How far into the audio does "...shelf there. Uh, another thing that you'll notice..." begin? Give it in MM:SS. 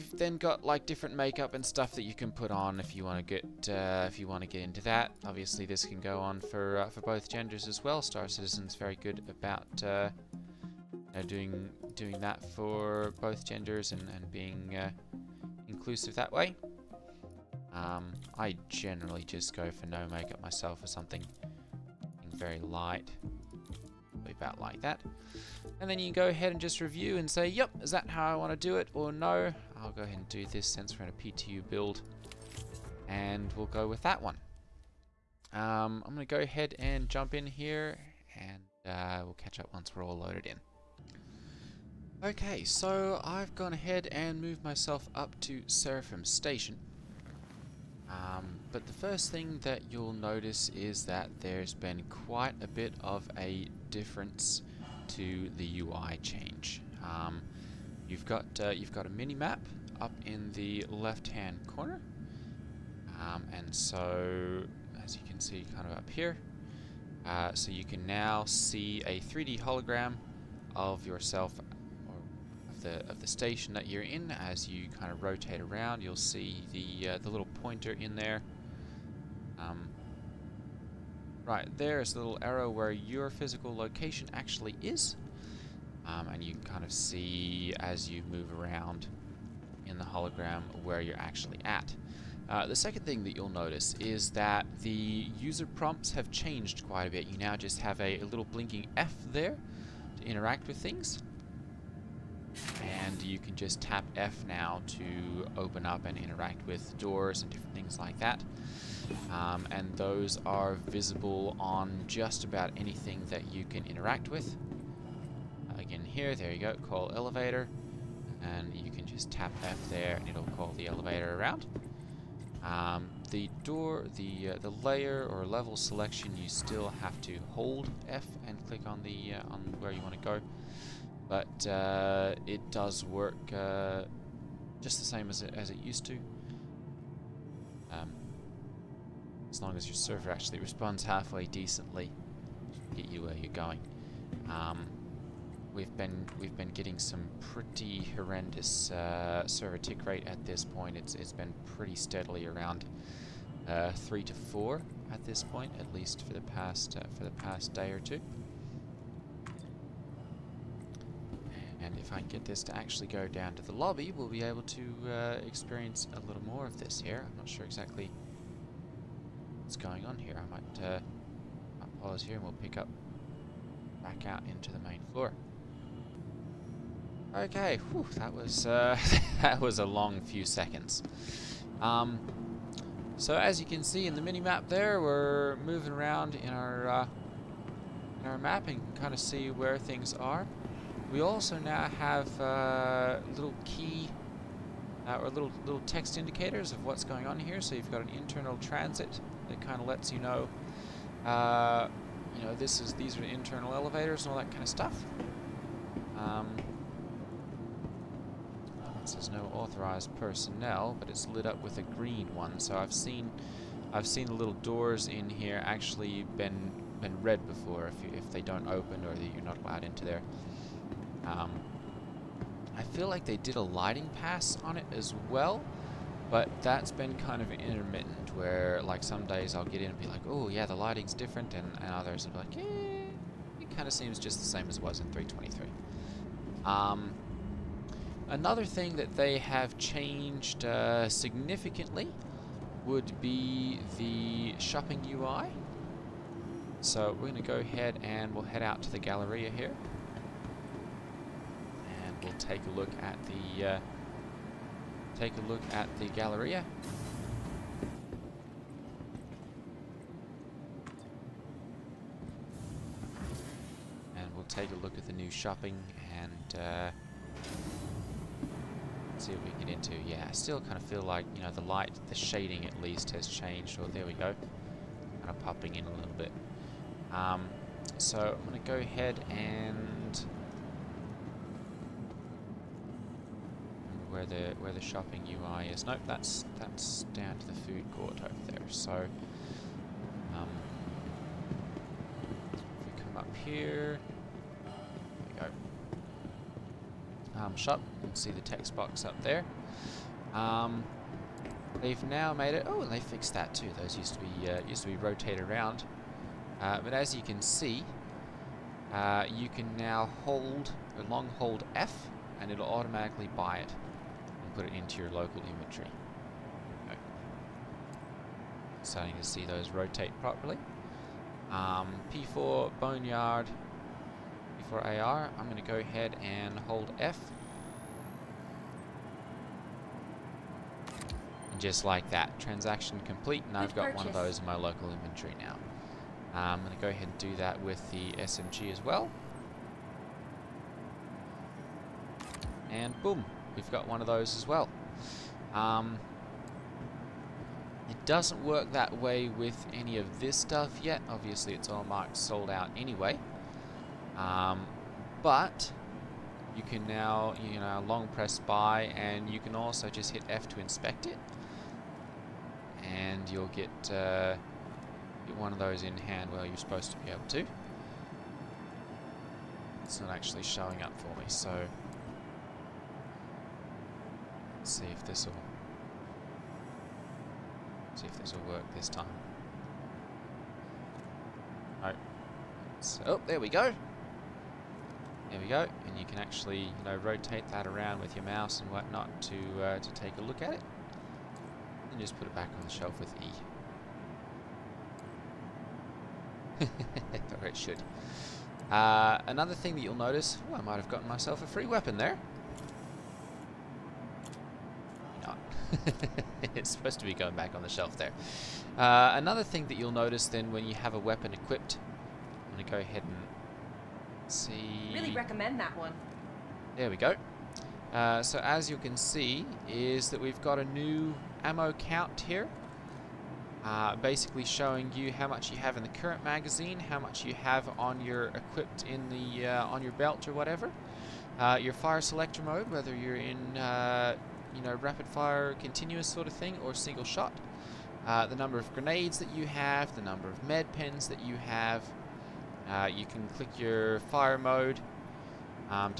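06:47.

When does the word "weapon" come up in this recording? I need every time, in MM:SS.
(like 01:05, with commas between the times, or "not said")
06:41, 06:50.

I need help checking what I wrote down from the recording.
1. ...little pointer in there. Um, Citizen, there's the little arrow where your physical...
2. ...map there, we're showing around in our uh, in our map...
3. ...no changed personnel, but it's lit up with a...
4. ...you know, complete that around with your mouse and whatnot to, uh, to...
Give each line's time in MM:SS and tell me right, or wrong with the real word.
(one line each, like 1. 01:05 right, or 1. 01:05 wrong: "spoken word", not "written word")
1. 01:17 wrong: "Right", not "Citizen"
2. 03:04 wrong: "moving", not "showing"
3. 03:29 wrong: "authorized", not "changed"
4. 06:26 wrong: "rotate", not "complete".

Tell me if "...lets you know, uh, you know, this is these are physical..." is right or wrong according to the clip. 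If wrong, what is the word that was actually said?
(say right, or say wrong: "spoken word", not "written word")
wrong: "internal", not "physical".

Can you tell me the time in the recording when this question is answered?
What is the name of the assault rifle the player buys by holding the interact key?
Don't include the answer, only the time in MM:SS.
05:22.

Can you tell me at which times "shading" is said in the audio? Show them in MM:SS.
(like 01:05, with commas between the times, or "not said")
04:32.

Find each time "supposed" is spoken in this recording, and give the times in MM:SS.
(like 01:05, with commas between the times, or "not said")
06:06, 06:46.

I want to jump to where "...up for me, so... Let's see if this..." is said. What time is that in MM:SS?
06:10.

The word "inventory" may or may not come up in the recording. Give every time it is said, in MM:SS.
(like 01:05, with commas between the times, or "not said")
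05:15, 05:34.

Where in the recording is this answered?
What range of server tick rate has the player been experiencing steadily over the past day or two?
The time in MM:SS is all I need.
02:33.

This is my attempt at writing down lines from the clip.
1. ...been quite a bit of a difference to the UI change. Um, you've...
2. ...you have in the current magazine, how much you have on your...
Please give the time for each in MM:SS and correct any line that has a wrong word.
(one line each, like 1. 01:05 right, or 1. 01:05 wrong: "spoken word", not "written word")
1. 00:51 right
2. 07:05 right.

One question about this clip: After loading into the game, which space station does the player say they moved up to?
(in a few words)
Seraphim Station.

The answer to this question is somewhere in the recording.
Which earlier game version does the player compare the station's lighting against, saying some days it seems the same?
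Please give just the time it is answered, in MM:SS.
03:55.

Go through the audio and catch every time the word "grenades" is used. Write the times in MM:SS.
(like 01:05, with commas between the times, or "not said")
07:18.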